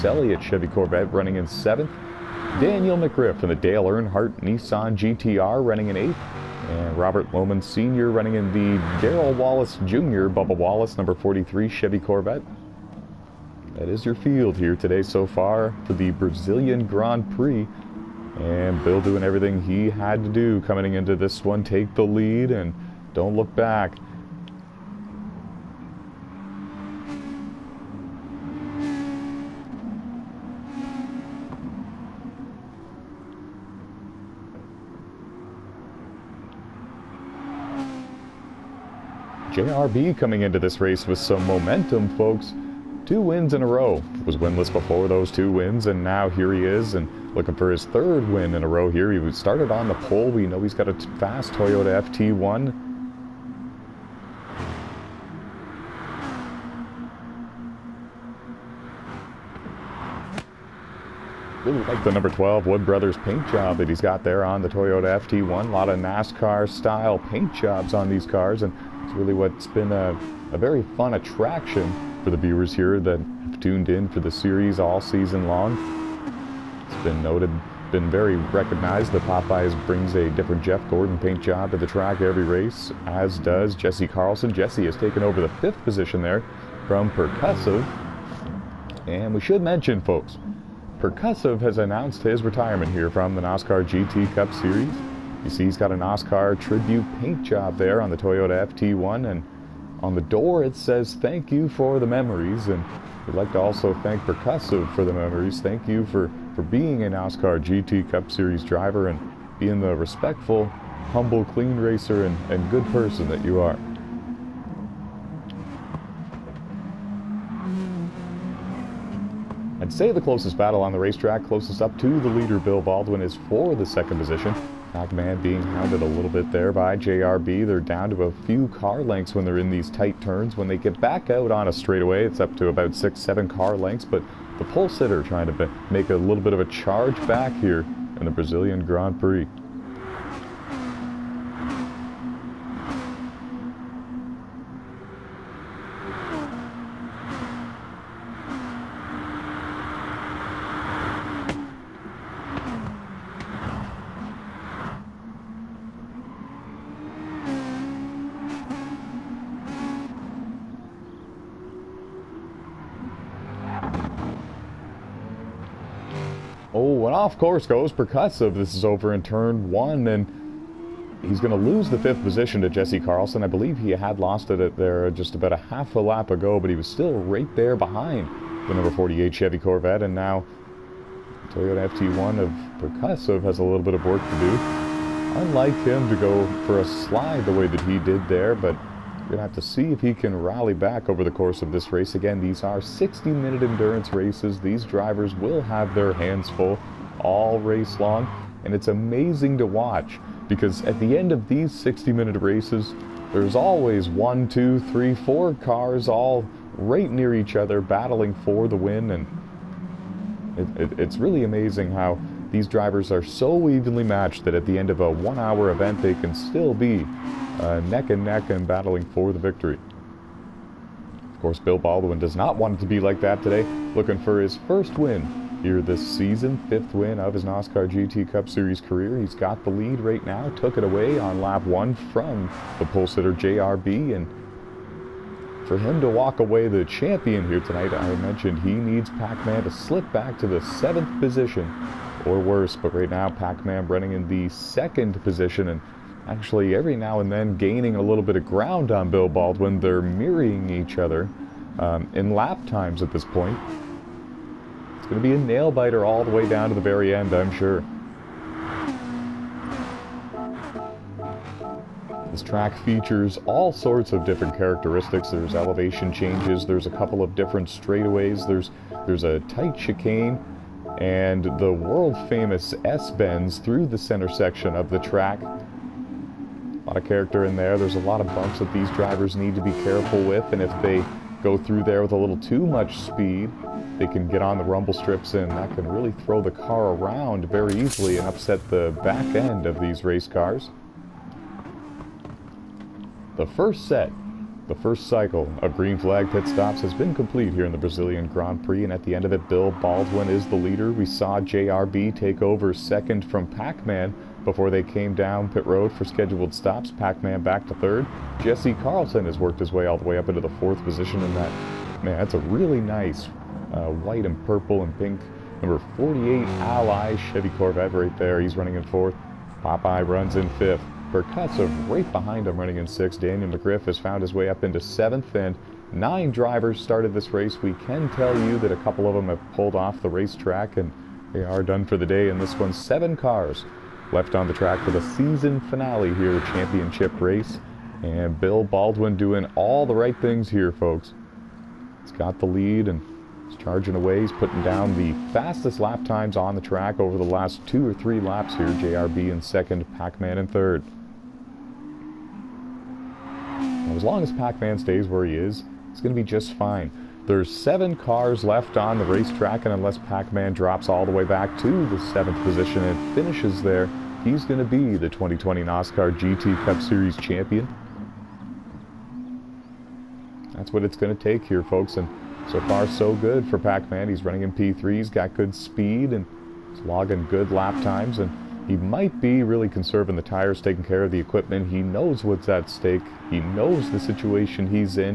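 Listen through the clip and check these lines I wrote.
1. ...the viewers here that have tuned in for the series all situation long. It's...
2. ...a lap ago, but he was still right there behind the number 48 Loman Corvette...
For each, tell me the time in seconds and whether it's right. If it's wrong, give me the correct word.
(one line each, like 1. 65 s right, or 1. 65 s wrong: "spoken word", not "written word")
1. 72 s wrong: "season", not "situation"
2. 175 s wrong: "Chevy", not "Loman".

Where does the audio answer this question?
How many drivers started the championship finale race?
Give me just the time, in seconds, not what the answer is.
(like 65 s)
325 s.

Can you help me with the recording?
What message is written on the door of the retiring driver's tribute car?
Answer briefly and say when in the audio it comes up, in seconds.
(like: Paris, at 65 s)
Thank you for the memories, at 101 s.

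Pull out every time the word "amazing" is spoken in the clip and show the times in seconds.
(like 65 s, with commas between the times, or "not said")
198 s, 211 s.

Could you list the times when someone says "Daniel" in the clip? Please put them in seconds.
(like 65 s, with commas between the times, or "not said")
2 s, 323 s.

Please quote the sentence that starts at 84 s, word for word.
Jesse has taken over the fifth position there from Percussive.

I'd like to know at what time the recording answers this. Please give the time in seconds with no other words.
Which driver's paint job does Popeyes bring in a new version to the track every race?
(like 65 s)
80 s.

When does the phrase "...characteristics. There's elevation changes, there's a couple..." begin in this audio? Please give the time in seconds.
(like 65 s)
264 s.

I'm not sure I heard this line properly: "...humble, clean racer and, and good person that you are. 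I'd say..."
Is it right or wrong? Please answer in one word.
right.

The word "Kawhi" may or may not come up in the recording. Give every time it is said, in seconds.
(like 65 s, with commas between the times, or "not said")
not said.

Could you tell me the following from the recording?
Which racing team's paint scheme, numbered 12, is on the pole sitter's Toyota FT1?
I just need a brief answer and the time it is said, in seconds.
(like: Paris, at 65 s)
Wood Brothers, at 62 s.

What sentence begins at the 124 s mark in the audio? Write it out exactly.
Pac-Man being hounded a little bit there by JRB.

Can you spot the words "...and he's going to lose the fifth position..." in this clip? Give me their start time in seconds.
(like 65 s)
170 s.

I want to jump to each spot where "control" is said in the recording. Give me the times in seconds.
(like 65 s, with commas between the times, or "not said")
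not said.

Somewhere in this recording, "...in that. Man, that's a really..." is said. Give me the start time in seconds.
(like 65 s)
311 s.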